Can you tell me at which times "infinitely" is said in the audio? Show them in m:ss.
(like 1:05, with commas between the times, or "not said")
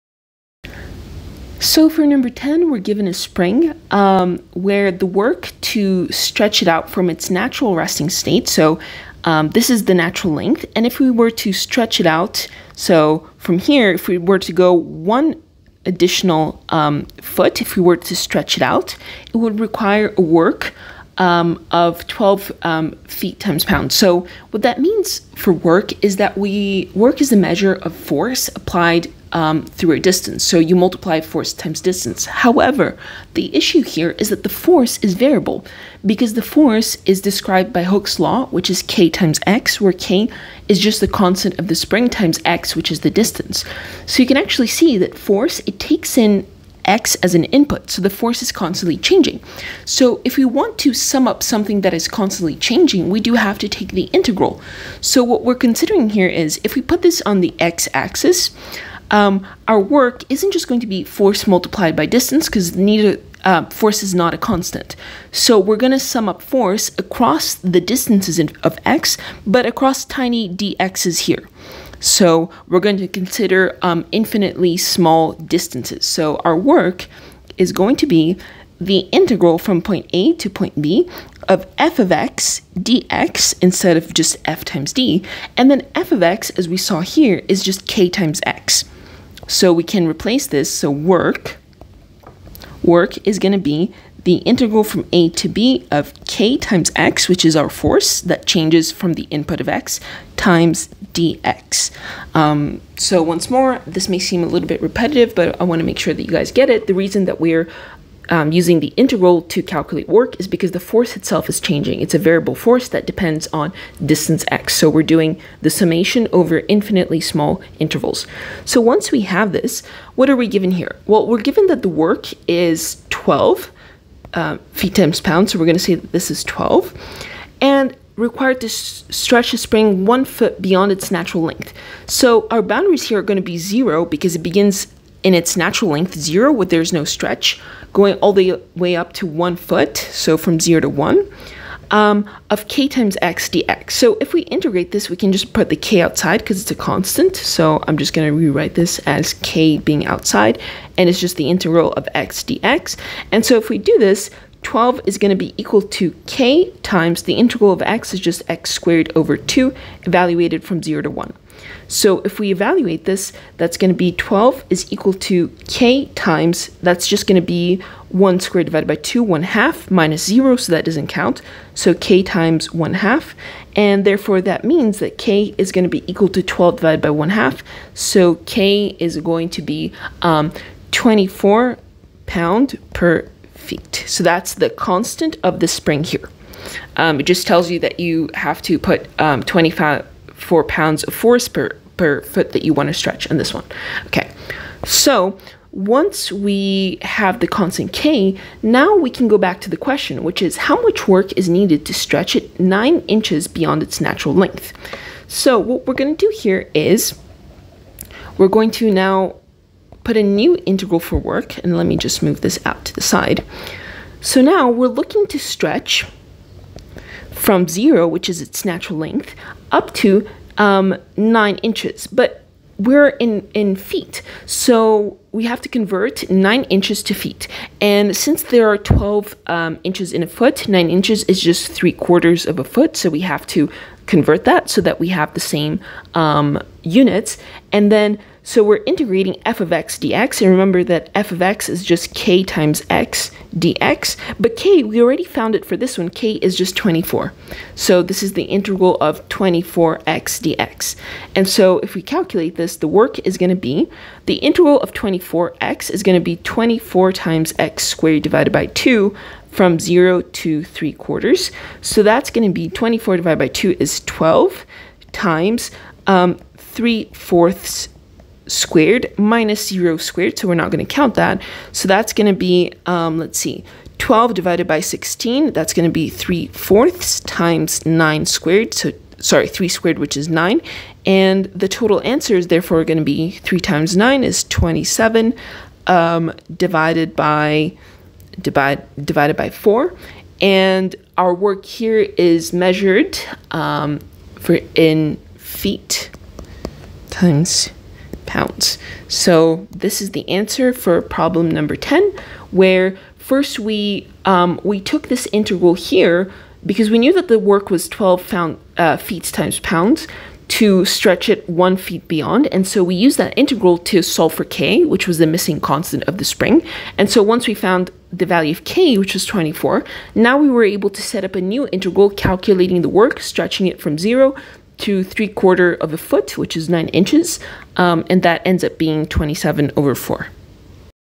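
1:14, 1:56.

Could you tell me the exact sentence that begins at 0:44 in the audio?
So you can actually see that force, it takes in x as an input, so the force is constantly changing.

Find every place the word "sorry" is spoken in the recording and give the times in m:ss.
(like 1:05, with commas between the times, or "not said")
4:39.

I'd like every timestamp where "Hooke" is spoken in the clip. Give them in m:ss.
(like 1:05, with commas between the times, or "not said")
0:37.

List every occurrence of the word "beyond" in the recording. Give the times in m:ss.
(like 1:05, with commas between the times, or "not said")
2:10, 3:23, 5:12.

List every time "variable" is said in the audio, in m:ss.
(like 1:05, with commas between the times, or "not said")
0:35, 1:52.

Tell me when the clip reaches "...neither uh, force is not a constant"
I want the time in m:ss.
1:02.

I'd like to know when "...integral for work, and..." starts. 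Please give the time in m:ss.
3:30.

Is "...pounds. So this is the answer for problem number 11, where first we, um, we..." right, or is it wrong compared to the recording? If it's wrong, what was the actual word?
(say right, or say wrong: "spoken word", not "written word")
wrong: "10", not "11".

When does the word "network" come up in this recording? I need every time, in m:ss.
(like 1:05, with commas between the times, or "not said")
not said.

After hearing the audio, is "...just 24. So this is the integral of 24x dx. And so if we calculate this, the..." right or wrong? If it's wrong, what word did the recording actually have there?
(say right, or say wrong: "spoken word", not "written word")
right.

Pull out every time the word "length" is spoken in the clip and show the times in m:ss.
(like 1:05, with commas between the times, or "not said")
0:10, 2:11, 2:15, 3:24, 3:38.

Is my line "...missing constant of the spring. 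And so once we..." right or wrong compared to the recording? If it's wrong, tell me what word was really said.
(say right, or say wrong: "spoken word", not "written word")
right.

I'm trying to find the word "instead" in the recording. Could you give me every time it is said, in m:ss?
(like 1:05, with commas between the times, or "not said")
1:23.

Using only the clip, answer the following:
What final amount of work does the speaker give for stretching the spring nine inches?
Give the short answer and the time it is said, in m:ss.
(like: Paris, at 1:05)
27/4 foot-pounds, at 5:29.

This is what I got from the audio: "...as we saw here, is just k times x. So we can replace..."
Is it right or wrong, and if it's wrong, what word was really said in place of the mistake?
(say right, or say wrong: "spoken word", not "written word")
right.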